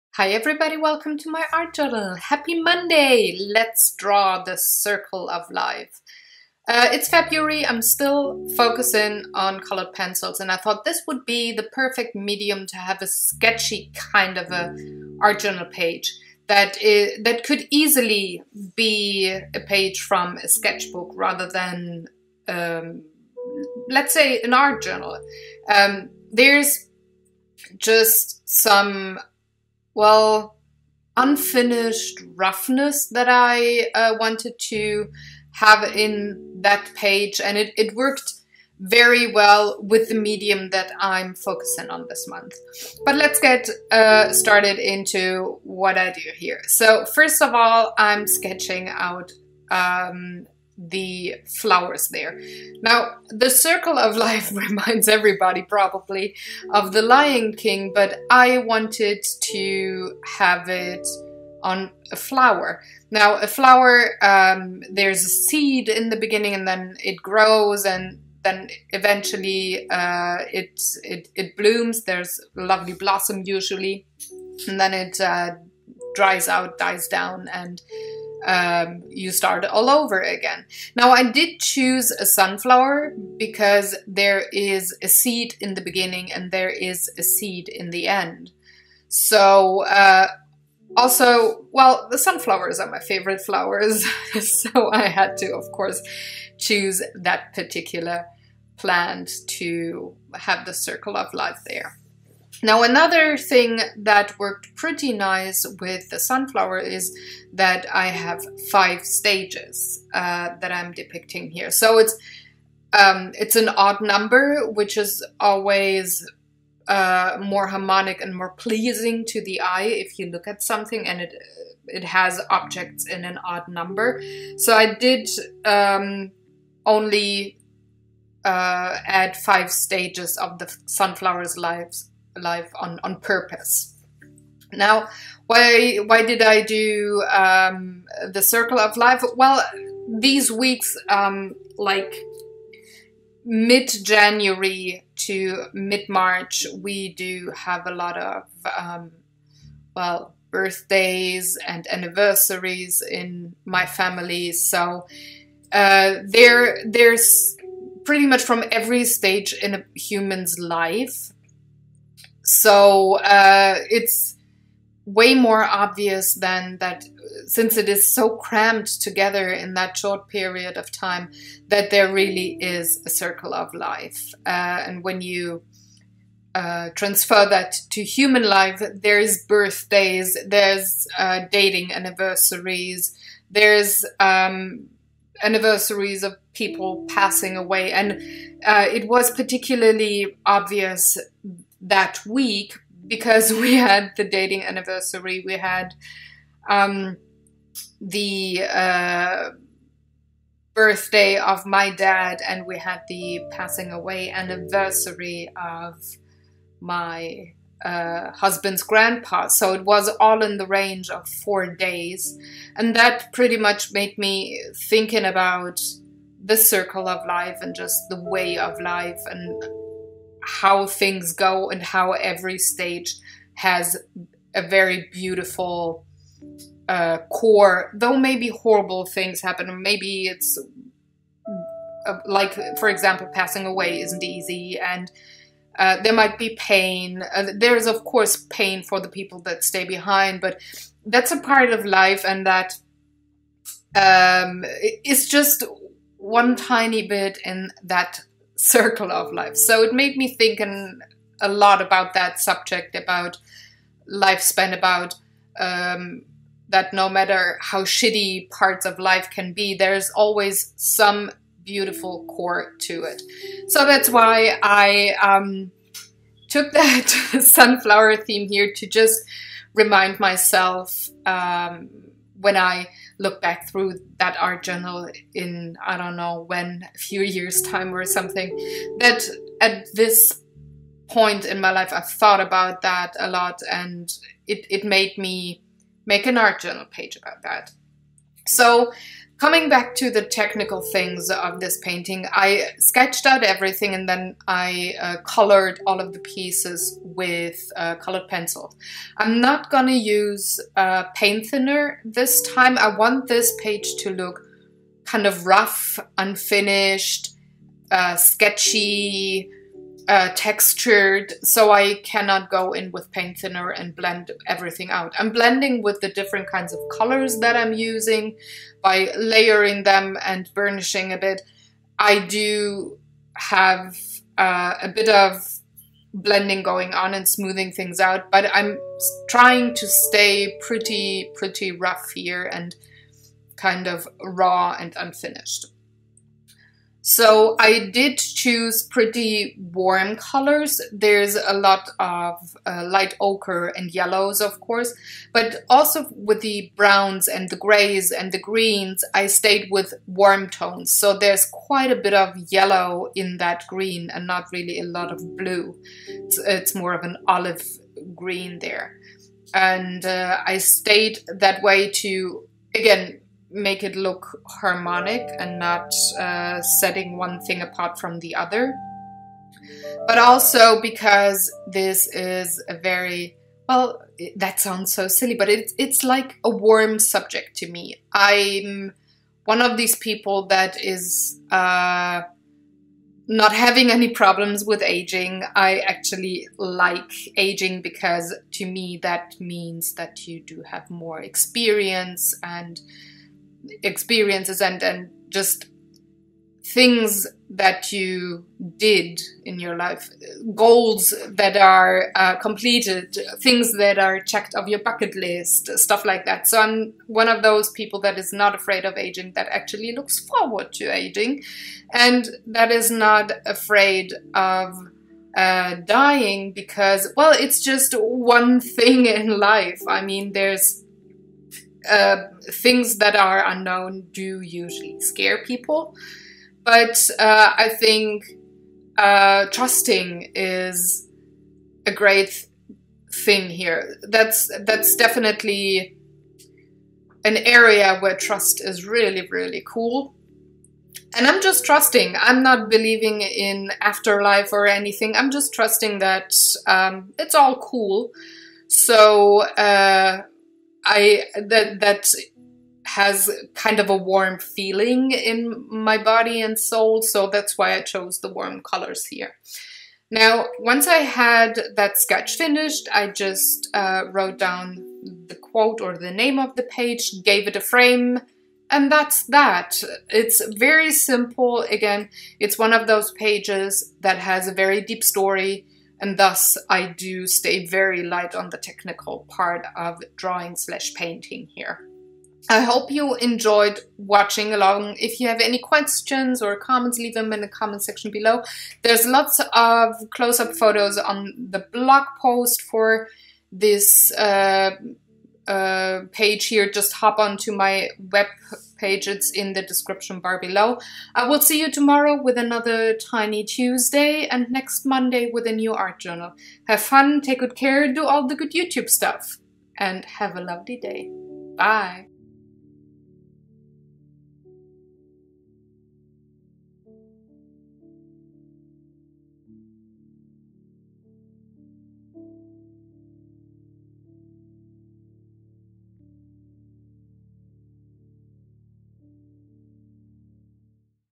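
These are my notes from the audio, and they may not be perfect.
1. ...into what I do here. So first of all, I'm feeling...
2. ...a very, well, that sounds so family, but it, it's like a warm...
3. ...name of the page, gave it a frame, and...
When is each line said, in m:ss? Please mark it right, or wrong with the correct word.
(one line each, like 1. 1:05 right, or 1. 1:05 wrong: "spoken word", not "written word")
1. 0:44 wrong: "sketching", not "feeling"
2. 6:12 wrong: "silly", not "family"
3. 7:46 right.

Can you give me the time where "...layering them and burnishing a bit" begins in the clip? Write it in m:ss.
5:19.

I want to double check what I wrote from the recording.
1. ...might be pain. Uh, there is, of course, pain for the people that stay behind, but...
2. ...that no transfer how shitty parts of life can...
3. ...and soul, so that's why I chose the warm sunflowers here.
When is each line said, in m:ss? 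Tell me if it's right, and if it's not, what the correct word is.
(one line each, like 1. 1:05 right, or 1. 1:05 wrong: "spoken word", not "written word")
1. 3:56 right
2. 4:16 wrong: "matter", not "transfer"
3. 7:36 wrong: "colors", not "sunflowers".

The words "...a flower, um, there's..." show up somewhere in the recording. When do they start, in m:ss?
1:03.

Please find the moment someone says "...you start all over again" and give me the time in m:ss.
1:19.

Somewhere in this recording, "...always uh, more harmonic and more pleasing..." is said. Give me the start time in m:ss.
1:55.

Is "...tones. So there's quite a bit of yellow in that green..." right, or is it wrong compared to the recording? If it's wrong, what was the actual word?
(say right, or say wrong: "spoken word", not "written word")
right.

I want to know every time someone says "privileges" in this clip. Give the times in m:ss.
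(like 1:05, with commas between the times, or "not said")
not said.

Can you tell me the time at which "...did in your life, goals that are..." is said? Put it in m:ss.
6:38.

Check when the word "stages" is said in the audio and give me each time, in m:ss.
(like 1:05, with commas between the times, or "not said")
1:49, 2:09, 2:39, 3:42.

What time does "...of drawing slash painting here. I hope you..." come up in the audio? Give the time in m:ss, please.
7:59.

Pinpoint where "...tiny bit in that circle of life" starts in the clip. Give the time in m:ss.
4:06.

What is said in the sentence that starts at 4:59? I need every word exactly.
I'm not gonna use uh, paint thinner this time.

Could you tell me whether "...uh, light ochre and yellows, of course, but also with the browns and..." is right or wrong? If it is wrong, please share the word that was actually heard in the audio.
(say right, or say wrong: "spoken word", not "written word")
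right.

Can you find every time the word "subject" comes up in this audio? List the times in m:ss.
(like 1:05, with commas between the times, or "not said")
4:12, 6:16.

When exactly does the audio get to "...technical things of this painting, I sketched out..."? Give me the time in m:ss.
4:50.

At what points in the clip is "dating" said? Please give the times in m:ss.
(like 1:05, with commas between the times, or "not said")
3:01, 3:14.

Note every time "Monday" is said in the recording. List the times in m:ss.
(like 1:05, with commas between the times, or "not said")
0:02, 8:24.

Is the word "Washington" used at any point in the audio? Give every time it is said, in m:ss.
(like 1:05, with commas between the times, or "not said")
not said.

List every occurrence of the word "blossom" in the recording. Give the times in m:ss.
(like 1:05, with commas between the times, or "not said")
1:12.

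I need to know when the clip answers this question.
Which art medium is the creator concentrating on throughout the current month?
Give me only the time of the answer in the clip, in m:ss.
0:09.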